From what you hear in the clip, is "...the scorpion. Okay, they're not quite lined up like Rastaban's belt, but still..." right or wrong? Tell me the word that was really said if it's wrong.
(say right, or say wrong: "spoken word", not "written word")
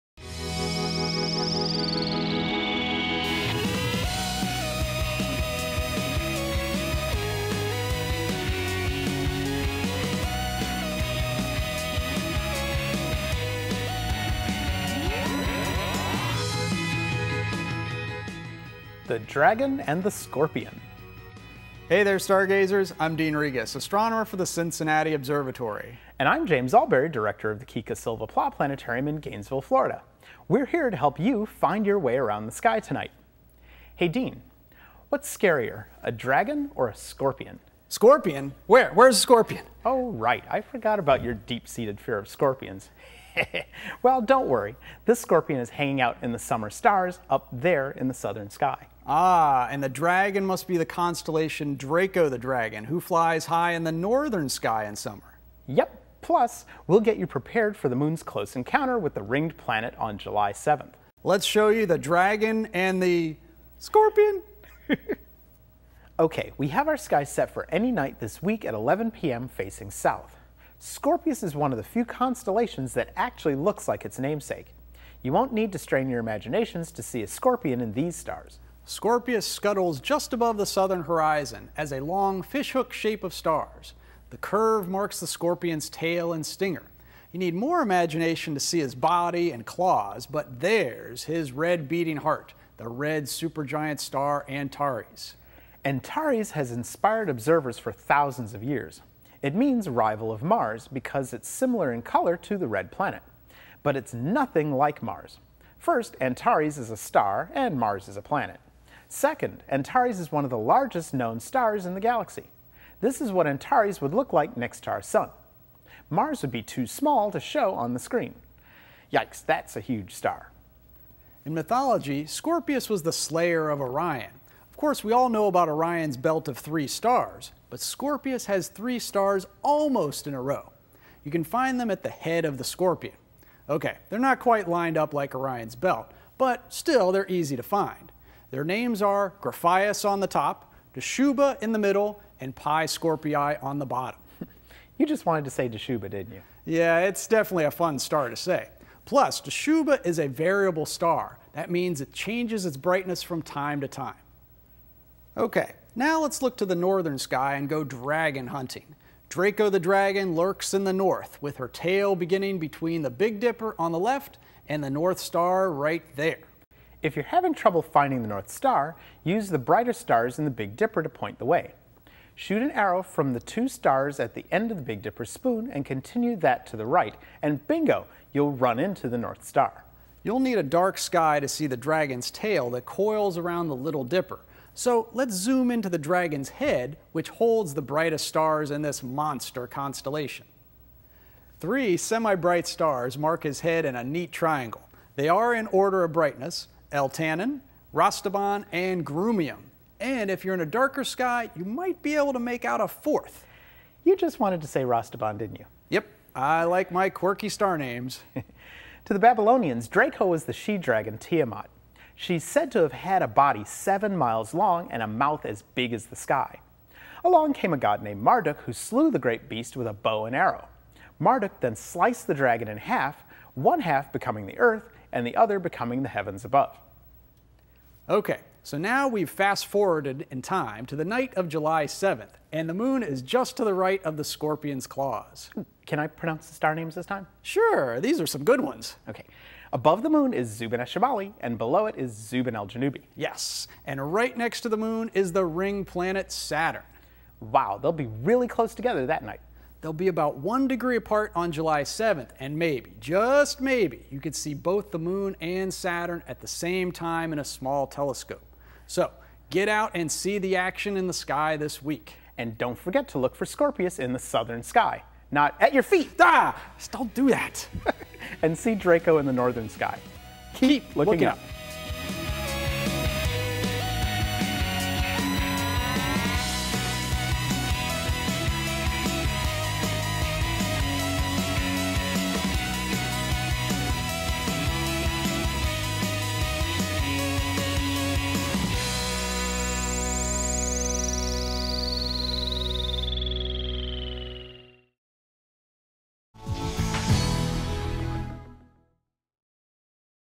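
wrong: "Orion", not "Rastaban".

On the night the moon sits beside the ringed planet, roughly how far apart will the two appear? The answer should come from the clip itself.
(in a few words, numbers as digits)
1 degree.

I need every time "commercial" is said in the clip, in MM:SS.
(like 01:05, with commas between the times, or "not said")
not said.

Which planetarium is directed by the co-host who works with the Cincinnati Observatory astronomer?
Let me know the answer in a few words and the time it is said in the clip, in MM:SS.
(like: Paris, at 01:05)
Kika Silva Pla Planetarium, at 00:27.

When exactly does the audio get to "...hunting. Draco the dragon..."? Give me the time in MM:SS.
02:38.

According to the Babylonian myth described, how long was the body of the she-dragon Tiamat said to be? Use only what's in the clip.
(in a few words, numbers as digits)
7 miles.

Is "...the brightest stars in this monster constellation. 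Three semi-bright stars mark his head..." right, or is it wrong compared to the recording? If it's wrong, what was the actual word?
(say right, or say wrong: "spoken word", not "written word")
right.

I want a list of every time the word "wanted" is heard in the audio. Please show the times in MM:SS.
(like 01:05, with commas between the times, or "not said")
02:25, 03:24.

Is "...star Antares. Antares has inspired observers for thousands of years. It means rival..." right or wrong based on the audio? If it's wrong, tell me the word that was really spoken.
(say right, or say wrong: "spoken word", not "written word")
right.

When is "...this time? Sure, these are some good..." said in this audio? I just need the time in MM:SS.
03:56.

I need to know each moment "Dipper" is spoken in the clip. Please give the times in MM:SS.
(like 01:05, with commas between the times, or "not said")
02:43, 02:50, 02:55, 03:04.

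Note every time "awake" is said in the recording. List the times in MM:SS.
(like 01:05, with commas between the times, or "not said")
not said.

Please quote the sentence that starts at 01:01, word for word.
Let's show you the dragon and the scorpion.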